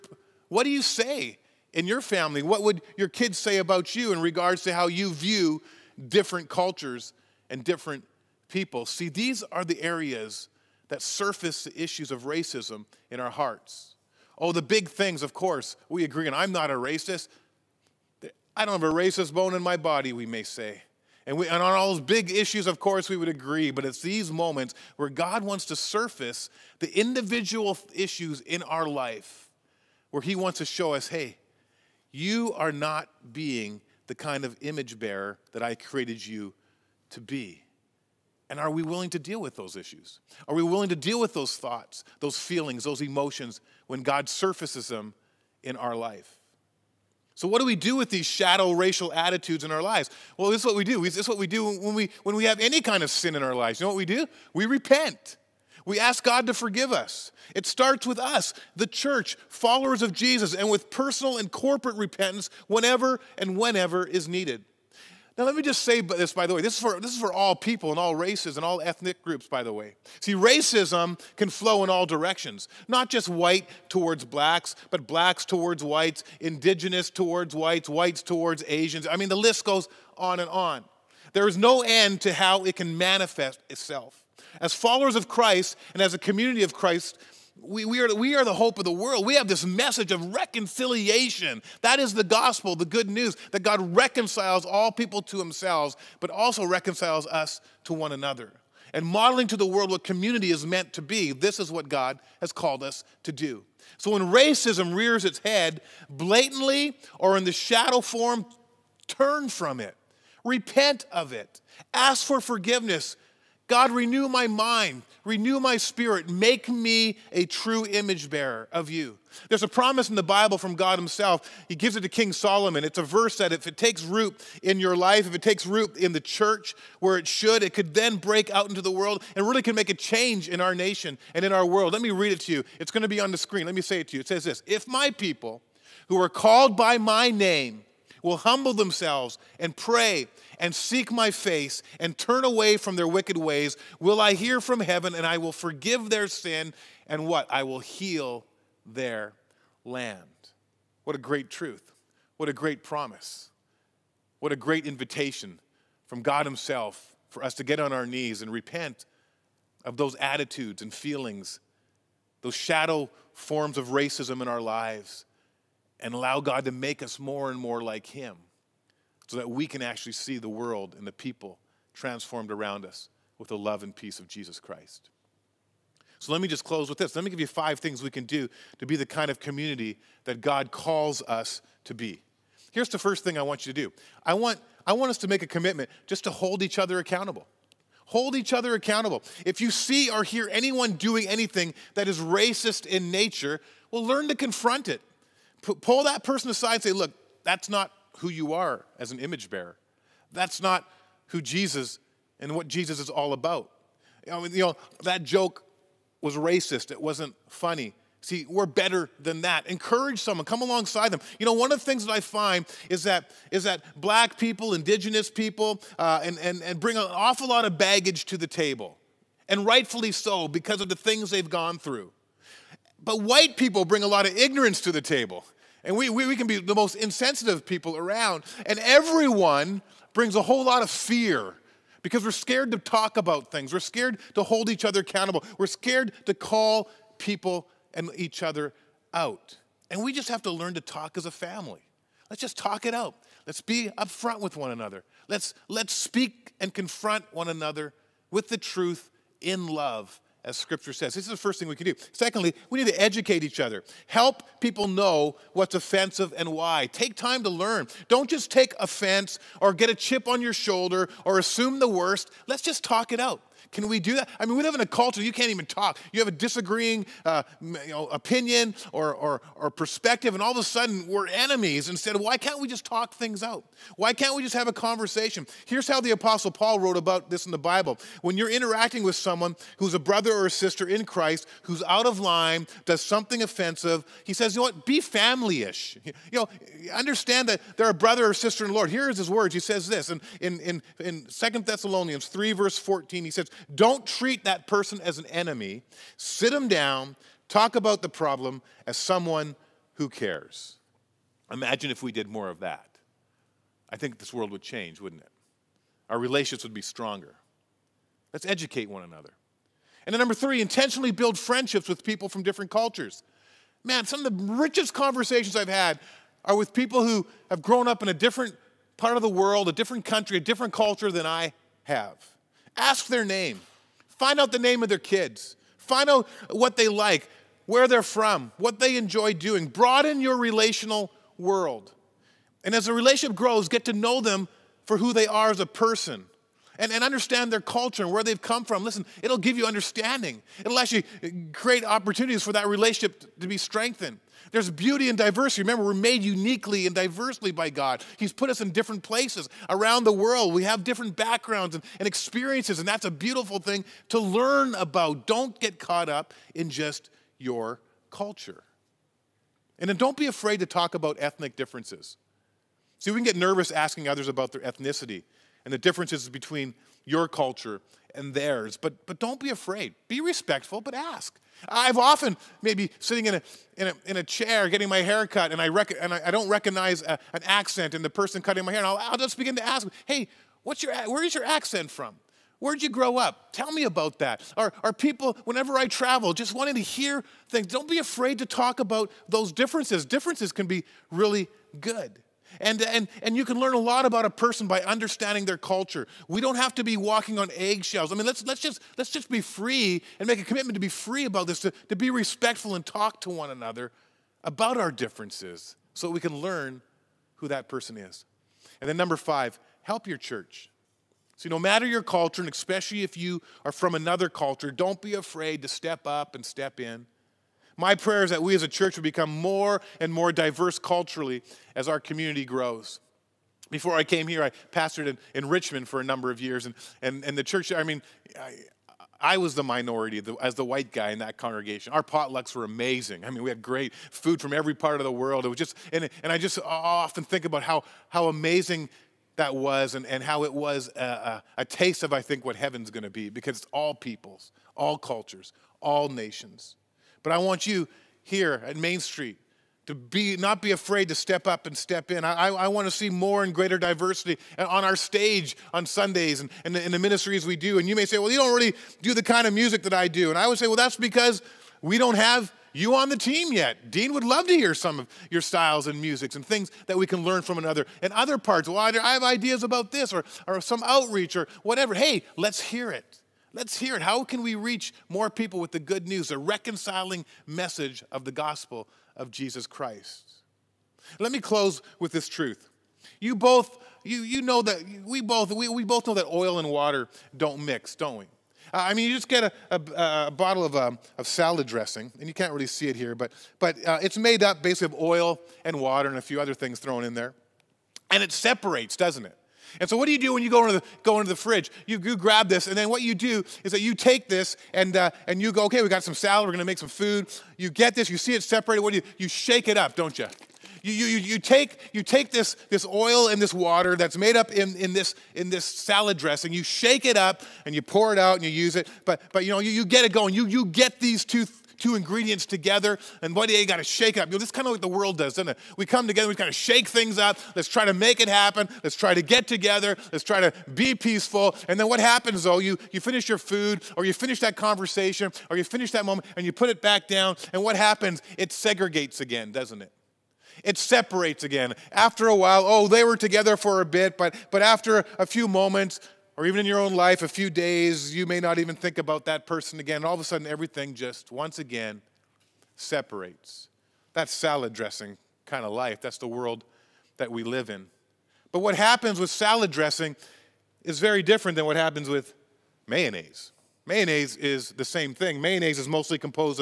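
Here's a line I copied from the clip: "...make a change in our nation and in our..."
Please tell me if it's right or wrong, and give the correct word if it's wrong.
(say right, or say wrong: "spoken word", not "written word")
right.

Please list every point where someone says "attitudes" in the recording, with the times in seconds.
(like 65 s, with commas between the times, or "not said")
49 s, 160 s.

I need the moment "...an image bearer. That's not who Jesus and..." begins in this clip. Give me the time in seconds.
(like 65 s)
199 s.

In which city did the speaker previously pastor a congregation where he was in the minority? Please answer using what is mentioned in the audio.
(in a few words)
Richmond.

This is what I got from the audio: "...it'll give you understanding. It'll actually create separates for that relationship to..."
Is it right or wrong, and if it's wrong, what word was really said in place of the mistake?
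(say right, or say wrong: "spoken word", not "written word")
wrong: "opportunities", not "separates".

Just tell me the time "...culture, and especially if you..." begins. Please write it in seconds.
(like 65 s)
412 s.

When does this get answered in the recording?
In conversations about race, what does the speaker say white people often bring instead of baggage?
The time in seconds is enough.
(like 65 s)
224 s.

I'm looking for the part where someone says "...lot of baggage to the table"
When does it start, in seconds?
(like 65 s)
217 s.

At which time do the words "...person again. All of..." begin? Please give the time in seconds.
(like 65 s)
549 s.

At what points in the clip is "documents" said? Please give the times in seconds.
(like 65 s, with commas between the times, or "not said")
not said.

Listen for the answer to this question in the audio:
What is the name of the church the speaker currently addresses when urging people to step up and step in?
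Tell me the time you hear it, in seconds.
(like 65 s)
448 s.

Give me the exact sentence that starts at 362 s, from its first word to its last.
See, we can get nervous asking others about their ethnicity and the differences between your culture and theirs.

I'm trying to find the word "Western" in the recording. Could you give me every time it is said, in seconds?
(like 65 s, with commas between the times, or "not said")
not said.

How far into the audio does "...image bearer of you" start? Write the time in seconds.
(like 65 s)
117 s.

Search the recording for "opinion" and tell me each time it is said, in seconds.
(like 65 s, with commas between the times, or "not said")
268 s.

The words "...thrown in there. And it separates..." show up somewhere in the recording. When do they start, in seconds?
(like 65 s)
496 s.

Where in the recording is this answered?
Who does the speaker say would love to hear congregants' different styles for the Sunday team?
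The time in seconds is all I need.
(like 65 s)
463 s.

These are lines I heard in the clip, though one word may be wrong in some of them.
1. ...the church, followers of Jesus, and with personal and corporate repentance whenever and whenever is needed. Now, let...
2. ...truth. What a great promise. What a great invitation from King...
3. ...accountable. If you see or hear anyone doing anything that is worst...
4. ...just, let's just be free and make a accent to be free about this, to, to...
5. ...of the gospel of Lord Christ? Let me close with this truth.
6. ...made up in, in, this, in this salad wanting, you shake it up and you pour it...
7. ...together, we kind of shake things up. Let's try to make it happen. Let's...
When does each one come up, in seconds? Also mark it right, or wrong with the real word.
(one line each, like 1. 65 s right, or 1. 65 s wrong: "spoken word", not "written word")
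1. 58 s right
2. 151 s wrong: "God", not "King"
3. 188 s wrong: "racist", not "worst"
4. 398 s wrong: "commitment", not "accent"
5. 478 s wrong: "Jesus", not "Lord"
6. 514 s wrong: "dressing", not "wanting"
7. 526 s right.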